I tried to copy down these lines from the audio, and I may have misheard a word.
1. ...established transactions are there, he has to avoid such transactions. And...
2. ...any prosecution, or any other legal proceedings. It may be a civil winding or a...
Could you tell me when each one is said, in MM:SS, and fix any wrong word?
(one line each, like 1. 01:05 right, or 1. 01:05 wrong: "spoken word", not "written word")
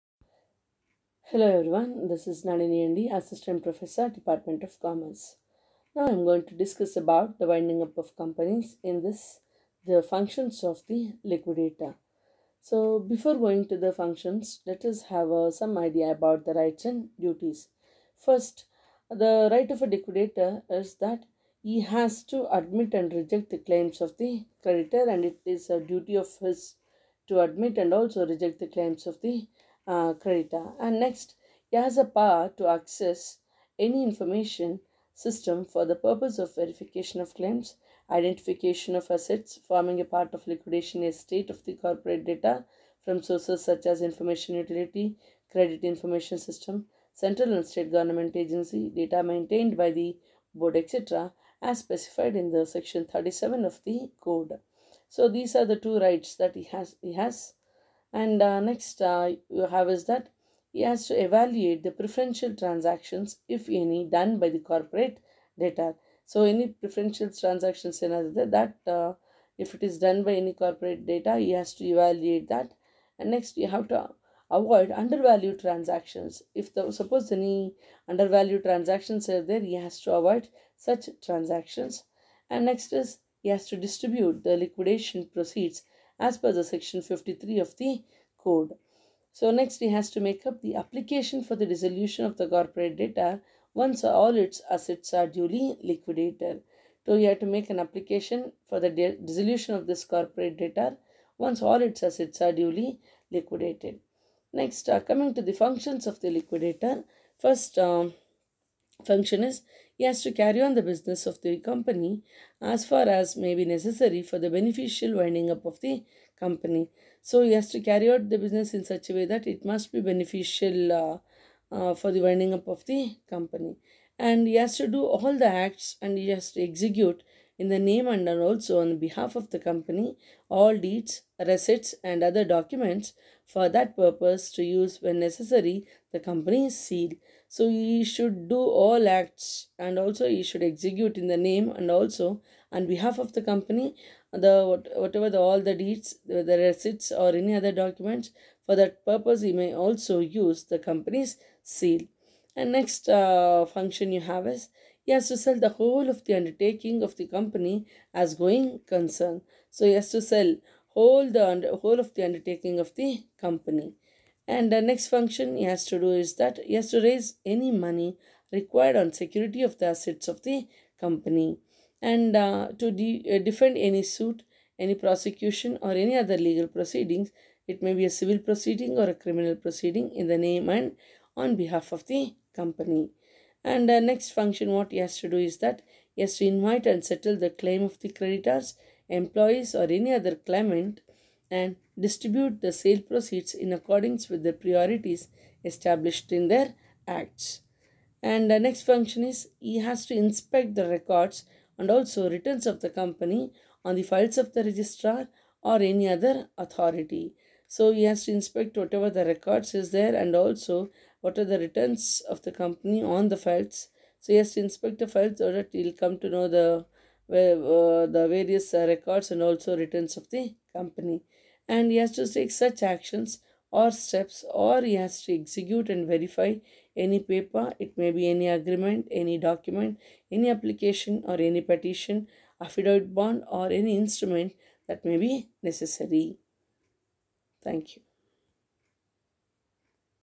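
1. 01:18 wrong: "undervalued", not "established"
2. 02:54 wrong: "proceeding", not "winding".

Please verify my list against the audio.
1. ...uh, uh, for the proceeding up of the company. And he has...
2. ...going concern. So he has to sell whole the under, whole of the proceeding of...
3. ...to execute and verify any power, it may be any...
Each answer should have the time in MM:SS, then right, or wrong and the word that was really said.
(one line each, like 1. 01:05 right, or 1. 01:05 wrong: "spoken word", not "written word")
1. 02:00 wrong: "winding", not "proceeding"
2. 02:38 wrong: "undertaking", not "proceeding"
3. 03:45 wrong: "paper", not "power".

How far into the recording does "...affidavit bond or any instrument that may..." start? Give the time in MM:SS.
03:52.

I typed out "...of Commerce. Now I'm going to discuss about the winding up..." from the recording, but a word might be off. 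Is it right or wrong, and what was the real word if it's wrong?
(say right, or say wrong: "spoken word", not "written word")
right.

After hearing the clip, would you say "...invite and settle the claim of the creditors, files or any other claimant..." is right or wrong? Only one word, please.
wrong.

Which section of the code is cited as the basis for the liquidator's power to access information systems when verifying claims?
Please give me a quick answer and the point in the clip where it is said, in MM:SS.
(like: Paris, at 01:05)
Section 37, at 00:52.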